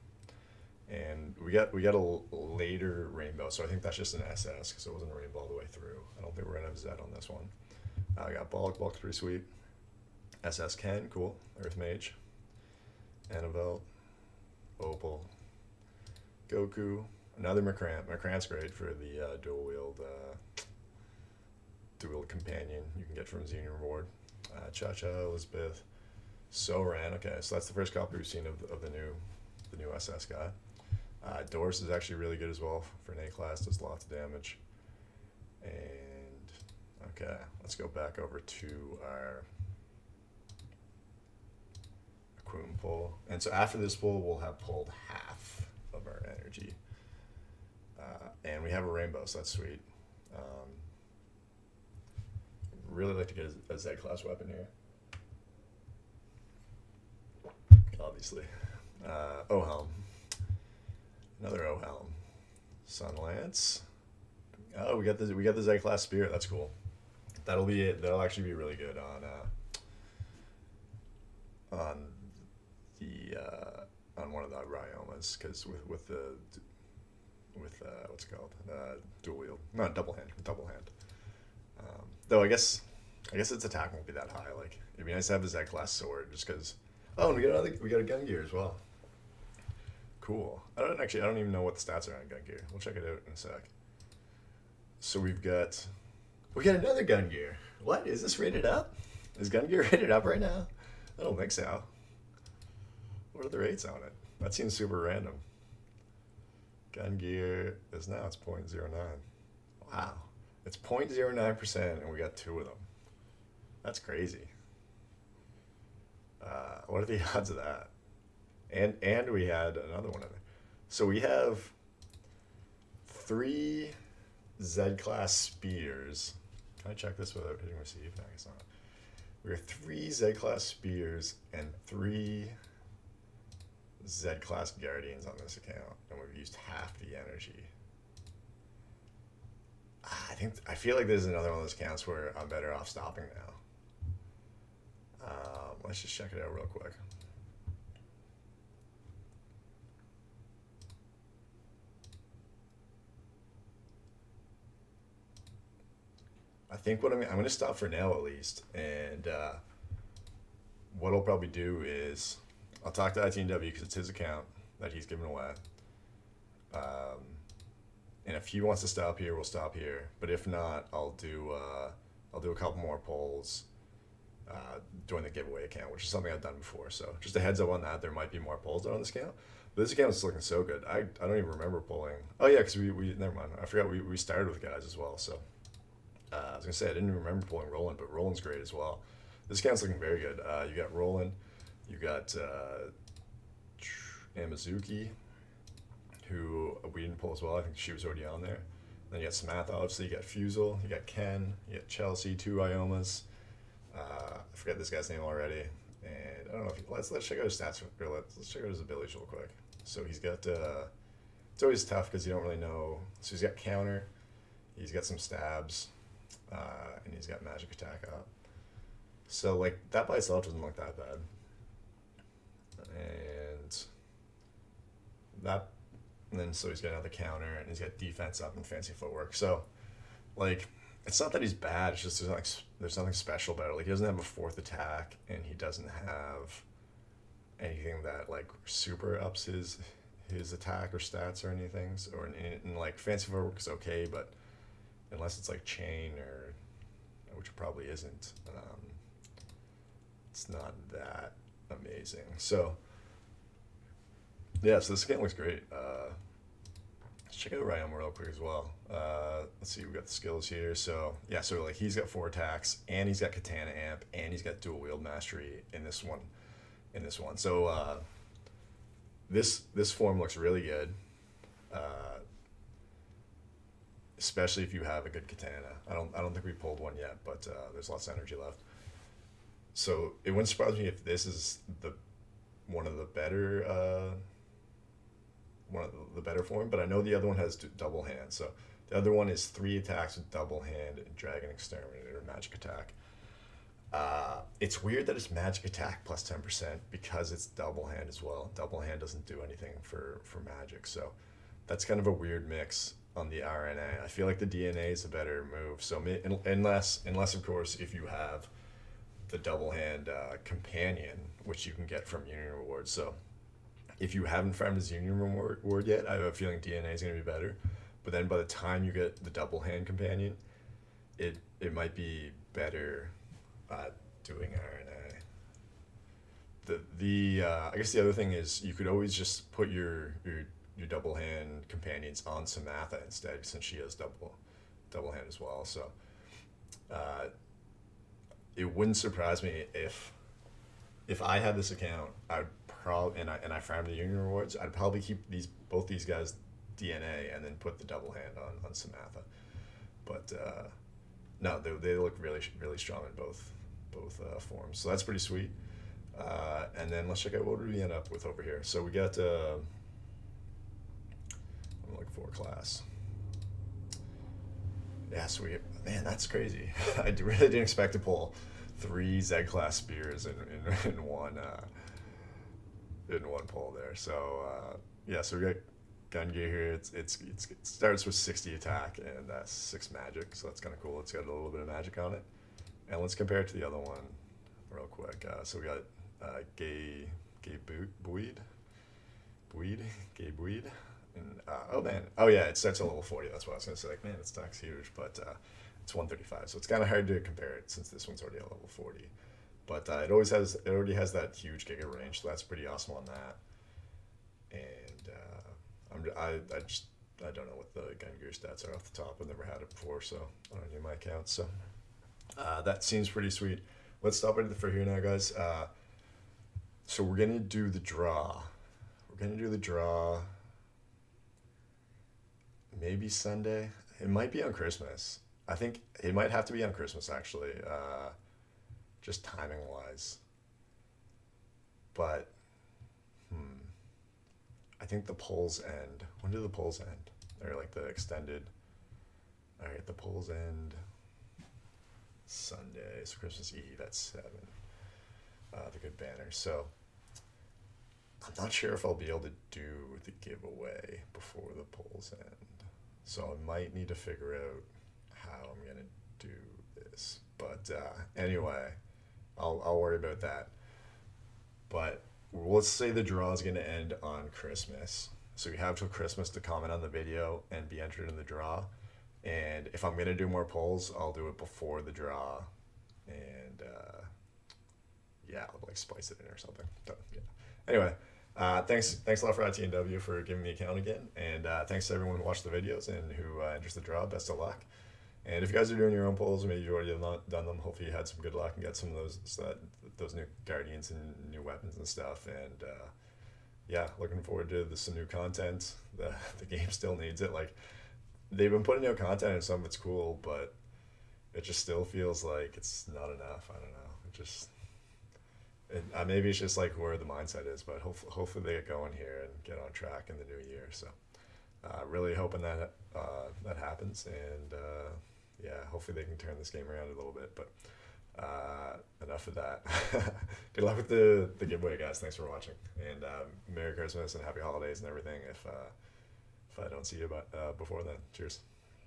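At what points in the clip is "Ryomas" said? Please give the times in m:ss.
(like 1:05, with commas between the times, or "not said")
1:14, 3:22.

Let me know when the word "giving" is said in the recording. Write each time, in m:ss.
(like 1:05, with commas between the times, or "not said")
2:45, 8:00.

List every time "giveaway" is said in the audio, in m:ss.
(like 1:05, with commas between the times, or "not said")
2:55, 7:30, 8:41.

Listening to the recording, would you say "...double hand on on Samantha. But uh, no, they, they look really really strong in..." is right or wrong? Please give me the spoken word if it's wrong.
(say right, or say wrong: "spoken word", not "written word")
right.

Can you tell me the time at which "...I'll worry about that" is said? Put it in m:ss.
7:39.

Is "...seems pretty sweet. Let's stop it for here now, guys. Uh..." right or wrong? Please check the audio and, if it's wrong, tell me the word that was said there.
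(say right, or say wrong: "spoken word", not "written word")
right.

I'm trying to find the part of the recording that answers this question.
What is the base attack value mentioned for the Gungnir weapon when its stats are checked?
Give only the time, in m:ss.
6:18.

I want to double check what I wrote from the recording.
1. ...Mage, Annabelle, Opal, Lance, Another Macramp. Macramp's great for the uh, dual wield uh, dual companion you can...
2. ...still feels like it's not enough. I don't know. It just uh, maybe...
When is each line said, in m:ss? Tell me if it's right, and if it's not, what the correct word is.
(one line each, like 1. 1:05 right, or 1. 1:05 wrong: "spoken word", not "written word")
1. 0:11 wrong: "Goku", not "Lance"
2. 8:21 right.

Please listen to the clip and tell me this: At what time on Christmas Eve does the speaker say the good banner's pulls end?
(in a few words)
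7.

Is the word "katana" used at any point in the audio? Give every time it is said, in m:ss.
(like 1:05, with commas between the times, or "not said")
4:23, 4:35.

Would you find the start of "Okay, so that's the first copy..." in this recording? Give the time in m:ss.
0:27.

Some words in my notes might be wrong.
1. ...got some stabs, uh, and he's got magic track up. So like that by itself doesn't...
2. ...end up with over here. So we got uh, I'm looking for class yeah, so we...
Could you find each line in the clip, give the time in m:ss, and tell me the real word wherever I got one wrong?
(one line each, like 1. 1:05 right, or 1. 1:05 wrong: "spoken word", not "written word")
1. 3:34 wrong: "attack", not "track"
2. 5:57 right.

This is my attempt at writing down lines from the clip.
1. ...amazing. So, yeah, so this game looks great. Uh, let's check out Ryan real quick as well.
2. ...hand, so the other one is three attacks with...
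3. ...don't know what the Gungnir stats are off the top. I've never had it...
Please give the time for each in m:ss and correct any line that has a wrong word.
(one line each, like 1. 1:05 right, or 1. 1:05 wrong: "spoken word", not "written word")
1. 4:11 right
2. 4:48 right
3. 6:47 right.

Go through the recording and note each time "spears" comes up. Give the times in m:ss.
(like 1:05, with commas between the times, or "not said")
1:06, 2:05, 2:10, 6:09.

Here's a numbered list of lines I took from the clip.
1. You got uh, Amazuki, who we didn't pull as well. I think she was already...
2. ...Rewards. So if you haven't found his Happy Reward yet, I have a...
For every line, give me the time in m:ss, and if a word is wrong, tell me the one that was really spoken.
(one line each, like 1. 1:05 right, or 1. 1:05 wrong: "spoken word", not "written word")
1. 3:11 right
2. 5:12 wrong: "Union", not "Happy".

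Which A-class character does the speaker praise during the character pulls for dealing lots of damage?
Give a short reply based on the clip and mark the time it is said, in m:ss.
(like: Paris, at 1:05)
Doris, at 0:31.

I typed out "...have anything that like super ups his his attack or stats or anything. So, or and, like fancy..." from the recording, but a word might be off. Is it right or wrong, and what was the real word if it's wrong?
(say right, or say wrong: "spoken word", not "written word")
right.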